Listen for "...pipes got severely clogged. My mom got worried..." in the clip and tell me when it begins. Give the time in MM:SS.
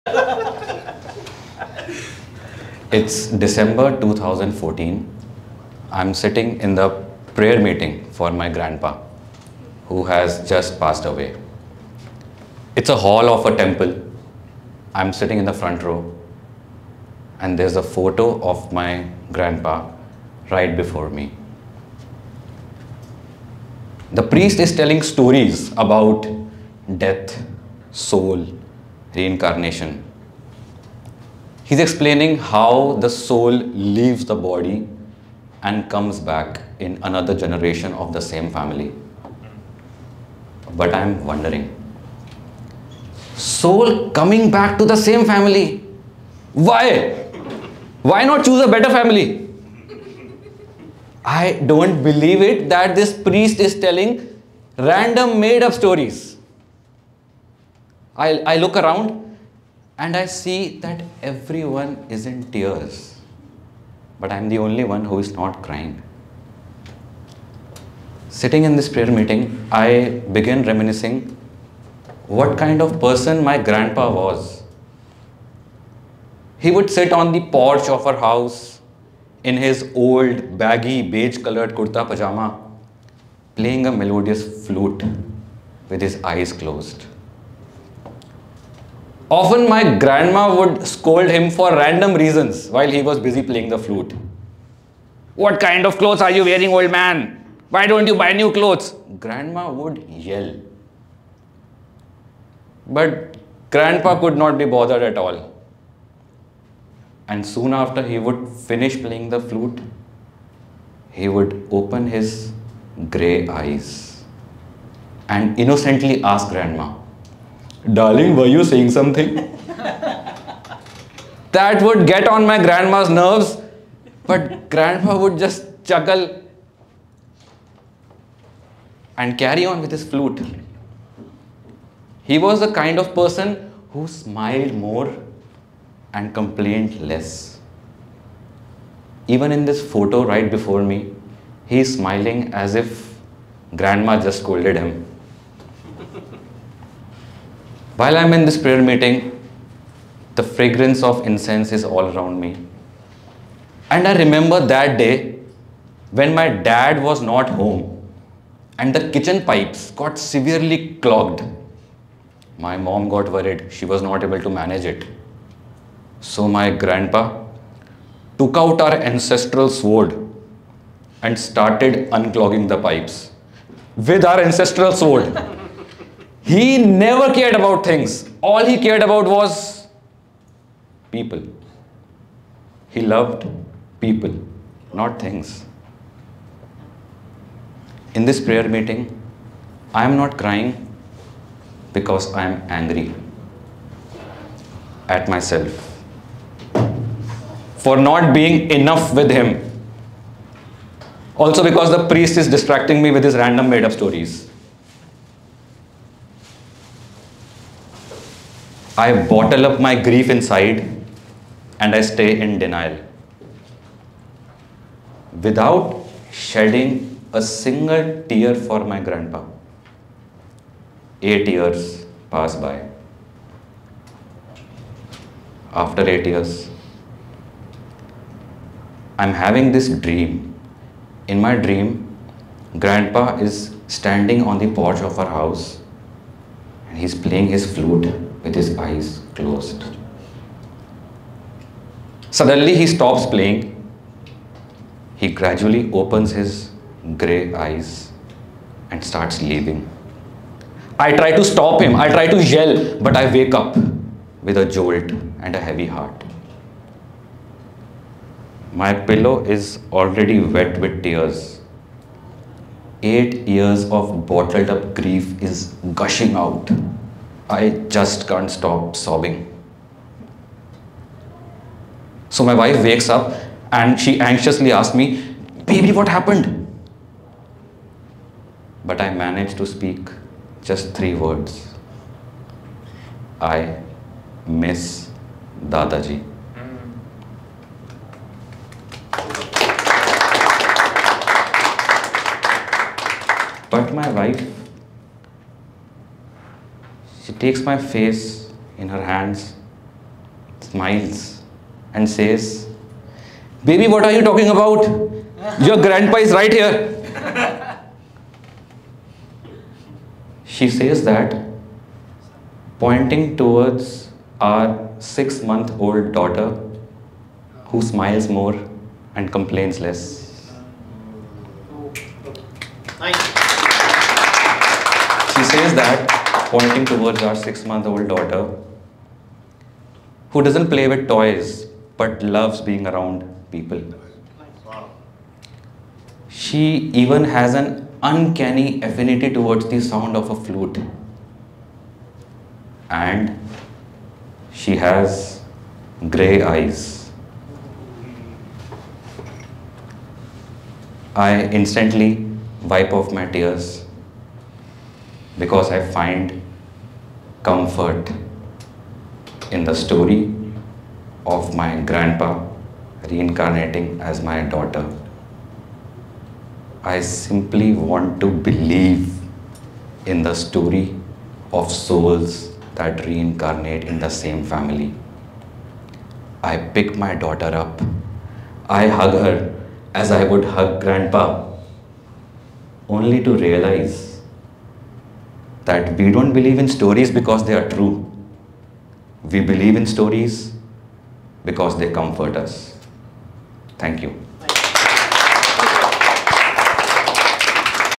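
02:39.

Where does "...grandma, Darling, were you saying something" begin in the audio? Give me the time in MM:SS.
01:56.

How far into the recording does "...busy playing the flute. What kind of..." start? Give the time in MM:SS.
01:33.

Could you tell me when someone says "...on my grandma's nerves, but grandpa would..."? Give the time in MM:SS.
02:02.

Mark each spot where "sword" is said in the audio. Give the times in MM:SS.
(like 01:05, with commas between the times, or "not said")
02:49, 02:54.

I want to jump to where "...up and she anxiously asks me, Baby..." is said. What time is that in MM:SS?
04:33.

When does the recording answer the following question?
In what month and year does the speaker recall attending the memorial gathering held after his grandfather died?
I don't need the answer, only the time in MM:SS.
00:03.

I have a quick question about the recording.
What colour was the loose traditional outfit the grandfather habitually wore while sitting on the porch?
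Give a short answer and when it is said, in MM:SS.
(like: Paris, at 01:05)
Beige, at 01:21.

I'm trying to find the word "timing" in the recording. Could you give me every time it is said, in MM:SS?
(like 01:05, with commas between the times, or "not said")
not said.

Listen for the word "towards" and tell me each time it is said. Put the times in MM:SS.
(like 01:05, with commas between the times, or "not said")
05:13, 05:26, 05:39.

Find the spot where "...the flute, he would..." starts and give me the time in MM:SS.
01:49.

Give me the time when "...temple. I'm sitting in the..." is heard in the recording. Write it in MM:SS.
00:13.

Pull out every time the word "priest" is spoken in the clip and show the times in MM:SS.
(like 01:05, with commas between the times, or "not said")
00:24, 00:53, 03:22.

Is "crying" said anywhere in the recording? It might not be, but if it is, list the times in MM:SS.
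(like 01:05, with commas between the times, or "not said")
01:05, 03:10.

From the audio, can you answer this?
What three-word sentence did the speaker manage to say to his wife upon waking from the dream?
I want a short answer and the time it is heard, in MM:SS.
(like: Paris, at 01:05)
I miss Dadaji, at 04:43.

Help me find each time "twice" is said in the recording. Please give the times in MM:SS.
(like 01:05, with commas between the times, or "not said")
not said.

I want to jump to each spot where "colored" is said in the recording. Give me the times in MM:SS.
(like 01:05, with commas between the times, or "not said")
01:21.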